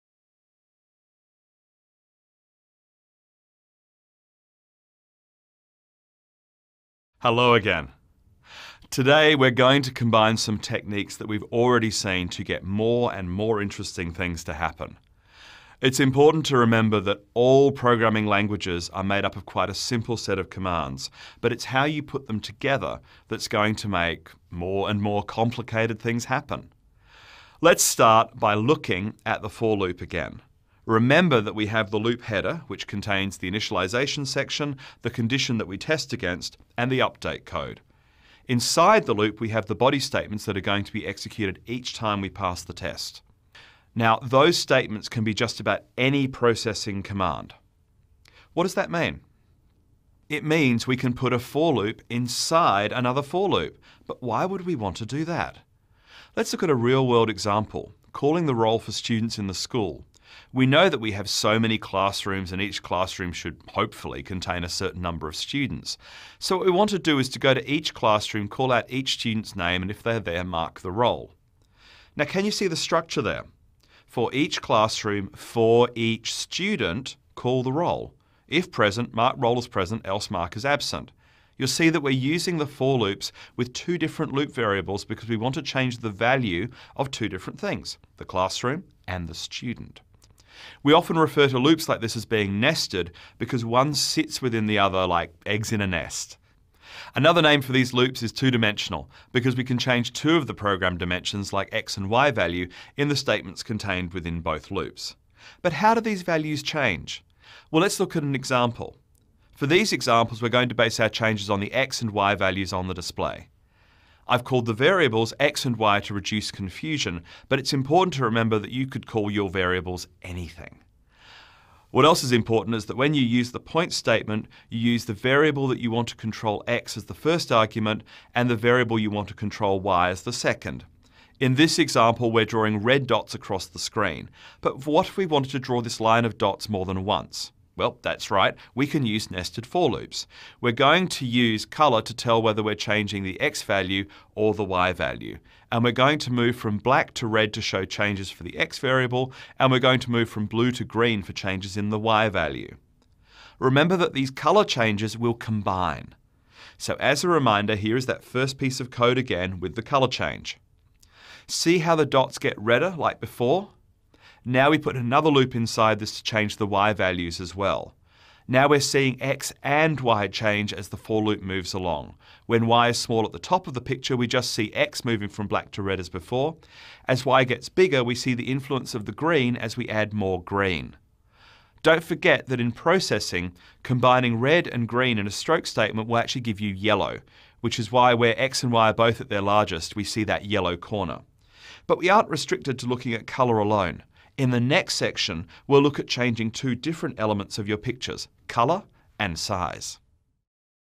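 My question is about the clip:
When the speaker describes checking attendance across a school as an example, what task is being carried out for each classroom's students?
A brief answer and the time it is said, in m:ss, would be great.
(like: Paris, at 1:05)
Calling the roll, at 0:58.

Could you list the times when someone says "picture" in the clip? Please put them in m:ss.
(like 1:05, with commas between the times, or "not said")
2:53, 3:17.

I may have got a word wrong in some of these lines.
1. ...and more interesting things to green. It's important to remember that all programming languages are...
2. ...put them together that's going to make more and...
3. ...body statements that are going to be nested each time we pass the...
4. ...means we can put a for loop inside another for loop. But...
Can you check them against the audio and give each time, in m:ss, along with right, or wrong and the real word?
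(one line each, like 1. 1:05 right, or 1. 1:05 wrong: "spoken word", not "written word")
1. 0:13 wrong: "happen", not "green"
2. 0:22 right
3. 0:39 wrong: "executed", not "nested"
4. 0:50 right.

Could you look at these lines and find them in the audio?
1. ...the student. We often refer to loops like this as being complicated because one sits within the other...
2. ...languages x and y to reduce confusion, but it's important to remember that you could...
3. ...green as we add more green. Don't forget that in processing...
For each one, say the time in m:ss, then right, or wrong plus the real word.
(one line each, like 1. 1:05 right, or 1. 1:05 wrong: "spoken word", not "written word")
1. 1:29 wrong: "nested", not "complicated"
2. 1:54 wrong: "variables", not "languages"
3. 2:59 right.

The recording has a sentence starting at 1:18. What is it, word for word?
If present, mark role as present, else mark as absent.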